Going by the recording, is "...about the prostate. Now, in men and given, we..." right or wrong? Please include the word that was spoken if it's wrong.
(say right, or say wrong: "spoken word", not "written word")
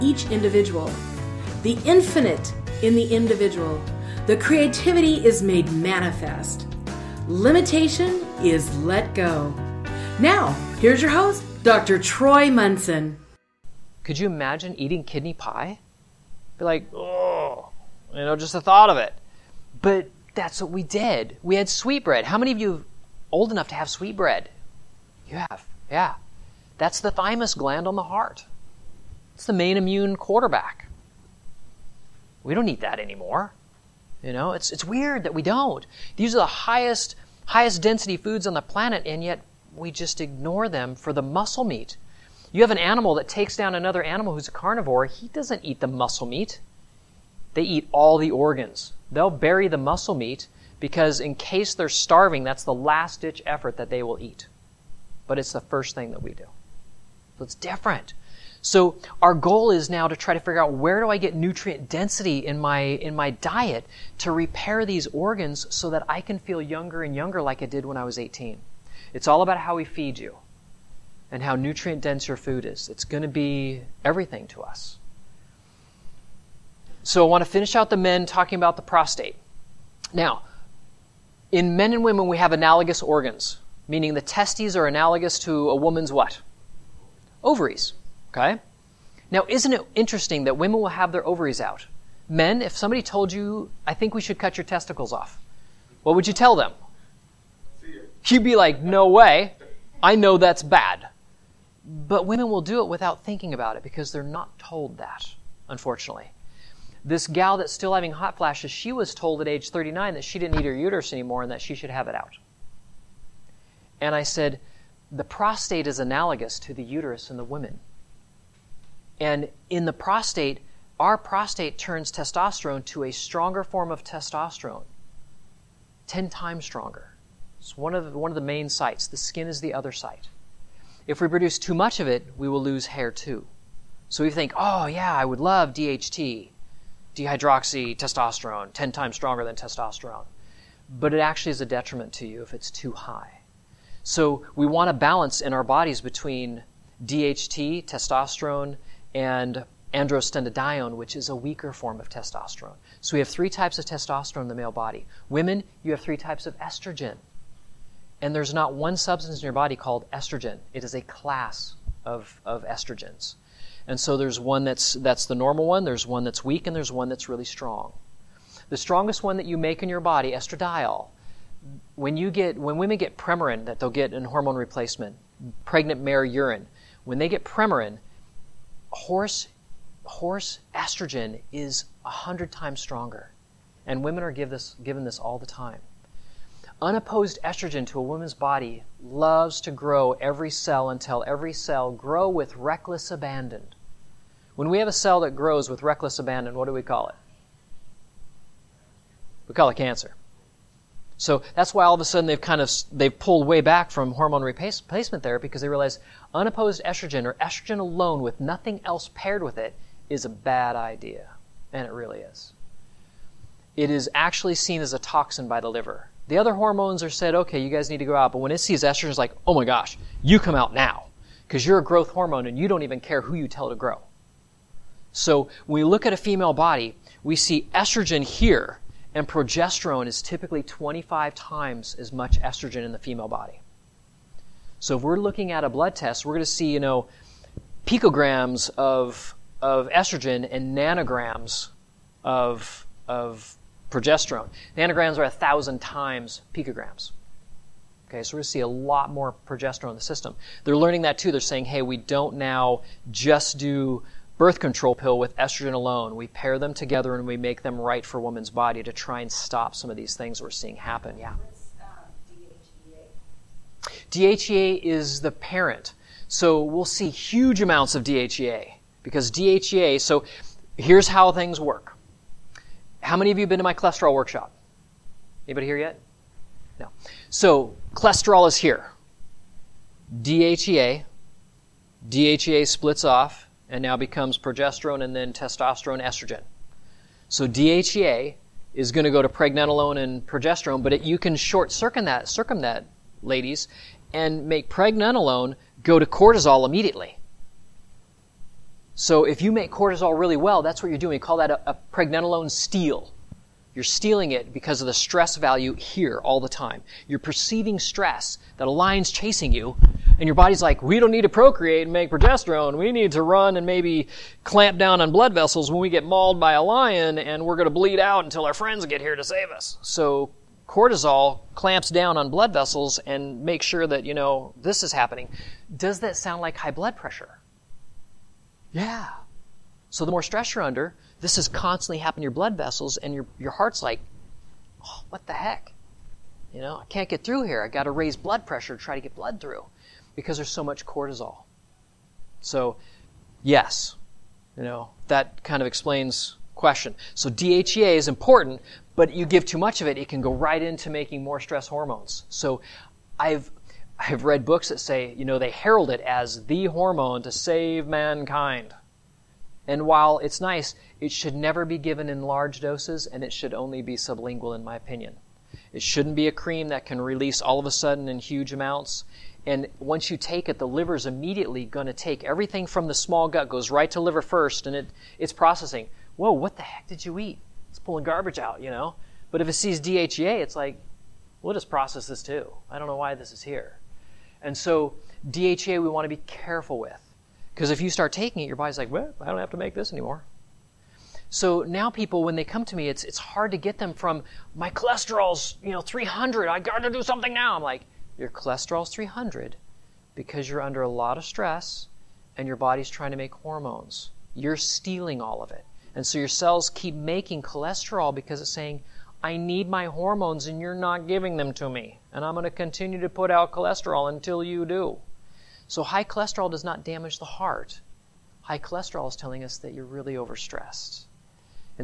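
wrong: "women", not "given".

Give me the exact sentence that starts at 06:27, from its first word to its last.
Because if you start taking it, your body's like, well, I don't have to make this anymore.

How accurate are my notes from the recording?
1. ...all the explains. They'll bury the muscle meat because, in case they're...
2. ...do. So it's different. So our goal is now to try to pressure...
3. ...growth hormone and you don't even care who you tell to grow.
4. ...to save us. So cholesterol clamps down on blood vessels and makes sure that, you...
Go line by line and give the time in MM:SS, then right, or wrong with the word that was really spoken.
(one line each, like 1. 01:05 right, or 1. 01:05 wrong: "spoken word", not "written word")
1. 00:47 wrong: "organs", not "explains"
2. 00:56 wrong: "figure", not "pressure"
3. 03:41 right
4. 05:19 wrong: "cortisol", not "cholesterol".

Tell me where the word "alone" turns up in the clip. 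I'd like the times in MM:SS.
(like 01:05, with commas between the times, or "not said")
03:27, 04:15.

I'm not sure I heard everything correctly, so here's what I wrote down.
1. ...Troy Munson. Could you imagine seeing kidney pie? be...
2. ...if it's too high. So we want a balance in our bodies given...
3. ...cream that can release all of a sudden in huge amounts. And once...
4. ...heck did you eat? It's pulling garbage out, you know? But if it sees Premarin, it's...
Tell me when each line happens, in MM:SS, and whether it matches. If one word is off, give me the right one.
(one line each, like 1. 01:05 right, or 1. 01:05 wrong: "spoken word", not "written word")
1. 00:11 wrong: "eating", not "seeing"
2. 02:22 wrong: "between", not "given"
3. 06:06 right
4. 06:16 wrong: "DHEA", not "Premarin".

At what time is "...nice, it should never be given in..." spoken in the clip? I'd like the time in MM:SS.
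06:00.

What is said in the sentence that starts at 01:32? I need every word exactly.
Men, if somebody told you, I think we should cut your testicles off, what would you tell them?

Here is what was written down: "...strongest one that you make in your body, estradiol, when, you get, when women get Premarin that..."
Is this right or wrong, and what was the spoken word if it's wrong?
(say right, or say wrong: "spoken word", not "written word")
right.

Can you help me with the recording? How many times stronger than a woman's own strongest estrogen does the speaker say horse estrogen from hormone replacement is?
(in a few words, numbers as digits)
100 times.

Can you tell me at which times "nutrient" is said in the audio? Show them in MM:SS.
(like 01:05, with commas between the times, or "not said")
01:01, 01:11.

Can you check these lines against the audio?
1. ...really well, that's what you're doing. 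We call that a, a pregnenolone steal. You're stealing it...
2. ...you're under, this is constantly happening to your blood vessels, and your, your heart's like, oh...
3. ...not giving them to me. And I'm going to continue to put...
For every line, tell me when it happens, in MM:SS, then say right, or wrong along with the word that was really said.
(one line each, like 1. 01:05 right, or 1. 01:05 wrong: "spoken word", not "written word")
1. 05:00 right
2. 05:30 right
3. 06:50 right.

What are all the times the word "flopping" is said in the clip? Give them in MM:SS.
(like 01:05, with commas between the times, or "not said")
not said.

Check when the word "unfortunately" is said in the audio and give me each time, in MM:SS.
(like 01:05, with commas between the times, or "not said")
01:45.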